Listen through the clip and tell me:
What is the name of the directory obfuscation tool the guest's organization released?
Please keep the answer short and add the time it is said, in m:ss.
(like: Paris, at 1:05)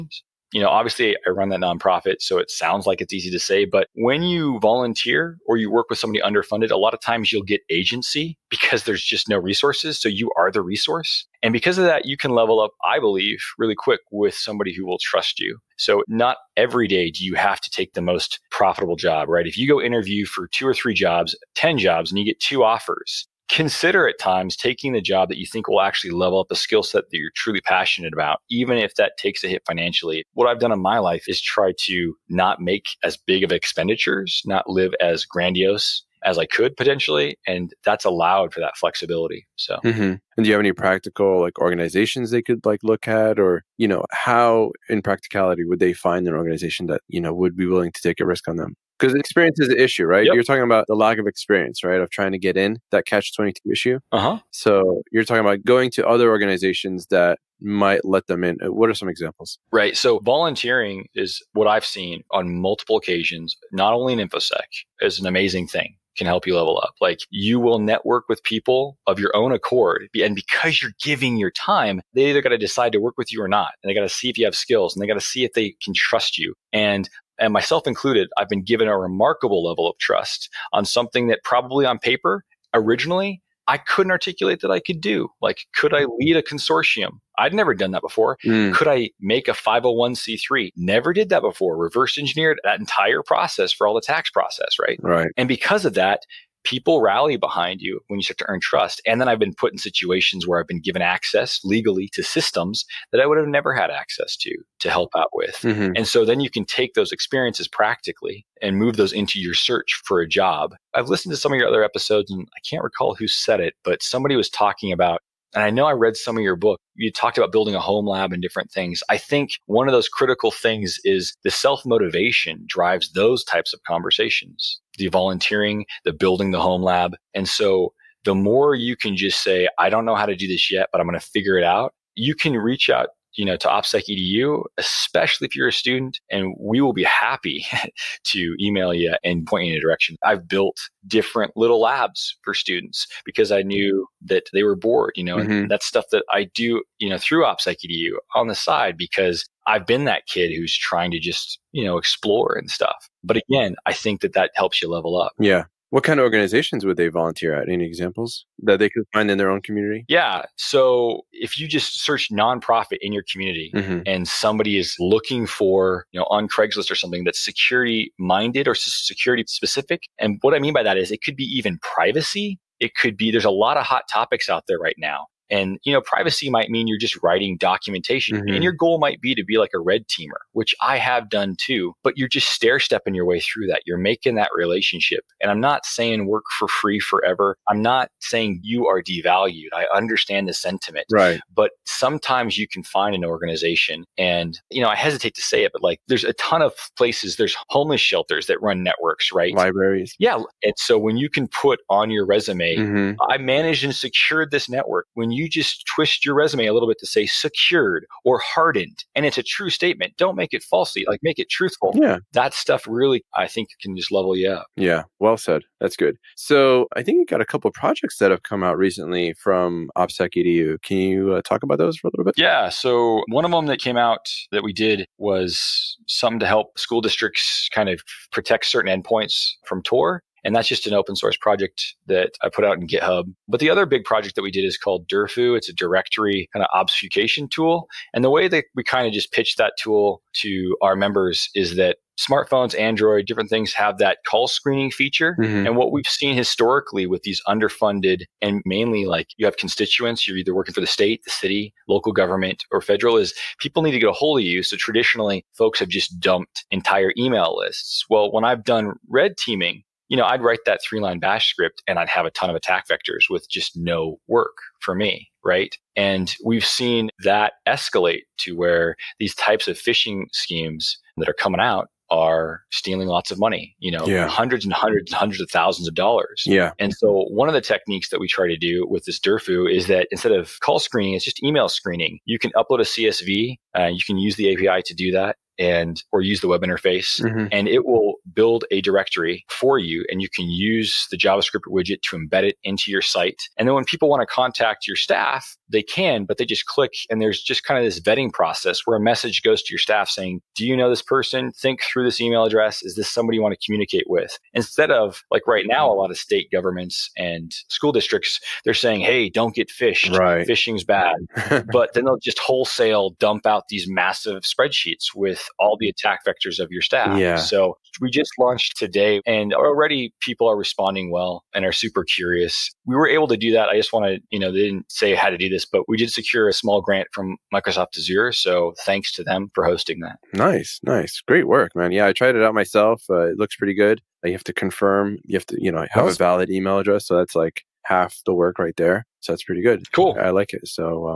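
Durfu, at 3:55.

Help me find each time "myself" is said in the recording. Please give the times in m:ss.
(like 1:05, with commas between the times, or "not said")
1:17, 5:32.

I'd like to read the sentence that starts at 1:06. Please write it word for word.
Like you will network with people of your own accord.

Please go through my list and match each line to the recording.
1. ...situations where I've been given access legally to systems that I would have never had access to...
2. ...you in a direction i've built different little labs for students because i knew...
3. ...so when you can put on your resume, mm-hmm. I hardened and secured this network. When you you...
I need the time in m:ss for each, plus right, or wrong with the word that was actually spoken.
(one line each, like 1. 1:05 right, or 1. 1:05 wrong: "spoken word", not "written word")
1. 1:39 right
2. 2:19 right
3. 3:20 wrong: "managed", not "hardened".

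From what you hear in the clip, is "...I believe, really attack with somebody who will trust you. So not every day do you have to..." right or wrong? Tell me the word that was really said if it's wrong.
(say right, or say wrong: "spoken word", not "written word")
wrong: "quick", not "attack".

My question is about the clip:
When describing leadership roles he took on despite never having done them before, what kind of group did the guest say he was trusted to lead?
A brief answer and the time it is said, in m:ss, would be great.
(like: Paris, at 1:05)
a consortium, at 1:26.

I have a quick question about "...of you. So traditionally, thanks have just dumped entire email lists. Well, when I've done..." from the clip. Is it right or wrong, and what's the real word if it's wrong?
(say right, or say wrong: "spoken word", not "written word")
wrong: "folks", not "thanks".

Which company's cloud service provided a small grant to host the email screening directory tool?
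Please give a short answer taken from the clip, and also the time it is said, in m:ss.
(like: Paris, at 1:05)
Microsoft Azure, at 5:27.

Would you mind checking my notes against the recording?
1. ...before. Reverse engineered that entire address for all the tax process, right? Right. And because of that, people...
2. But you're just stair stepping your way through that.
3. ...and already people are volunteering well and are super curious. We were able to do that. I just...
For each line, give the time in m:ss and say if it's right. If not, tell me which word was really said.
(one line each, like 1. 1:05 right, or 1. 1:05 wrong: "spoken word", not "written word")
1. 1:31 wrong: "process", not "address"
2. 3:02 right
3. 5:19 wrong: "responding", not "volunteering".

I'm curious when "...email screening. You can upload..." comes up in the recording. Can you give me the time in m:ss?
4:41.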